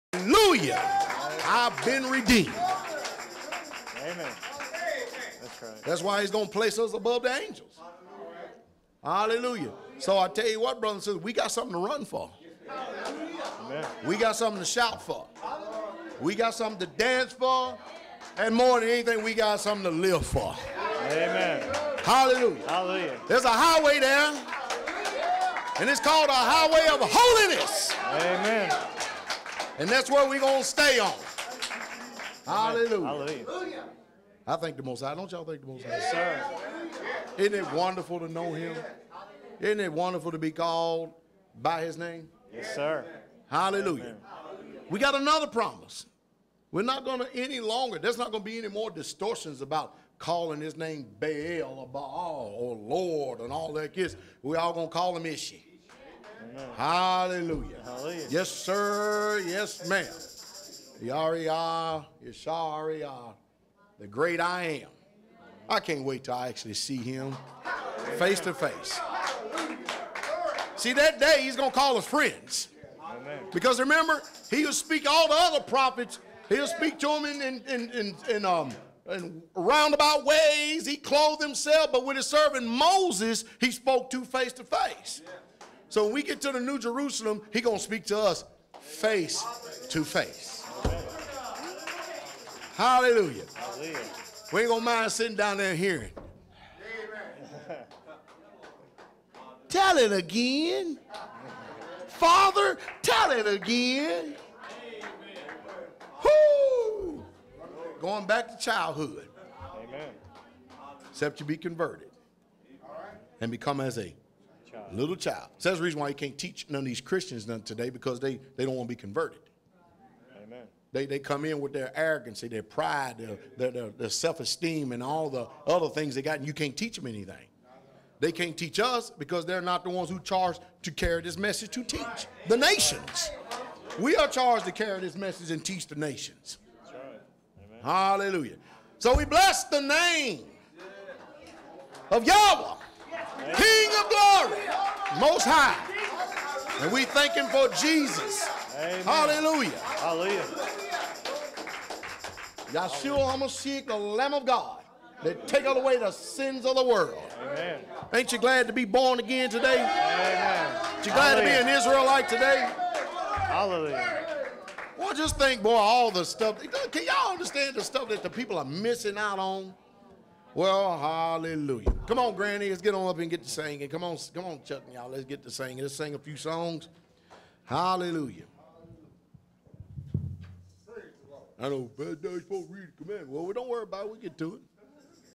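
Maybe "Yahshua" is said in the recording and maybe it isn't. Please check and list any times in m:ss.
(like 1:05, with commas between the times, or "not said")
2:32.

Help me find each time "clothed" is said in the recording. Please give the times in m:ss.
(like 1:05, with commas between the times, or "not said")
1:20.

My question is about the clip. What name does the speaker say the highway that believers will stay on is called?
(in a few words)
highway of holiness.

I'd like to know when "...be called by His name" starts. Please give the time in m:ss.
0:40.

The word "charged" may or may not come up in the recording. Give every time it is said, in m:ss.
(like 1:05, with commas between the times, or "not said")
2:10, 2:14.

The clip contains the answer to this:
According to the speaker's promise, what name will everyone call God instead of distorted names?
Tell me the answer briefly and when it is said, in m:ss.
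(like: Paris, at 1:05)
Ishi, at 0:55.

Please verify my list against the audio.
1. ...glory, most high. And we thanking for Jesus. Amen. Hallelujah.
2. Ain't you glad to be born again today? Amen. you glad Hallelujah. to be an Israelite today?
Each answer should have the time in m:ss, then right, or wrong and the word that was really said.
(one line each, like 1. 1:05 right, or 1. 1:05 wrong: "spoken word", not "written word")
1. 2:24 right
2. 2:38 right.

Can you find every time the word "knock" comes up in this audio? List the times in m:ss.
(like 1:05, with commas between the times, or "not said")
not said.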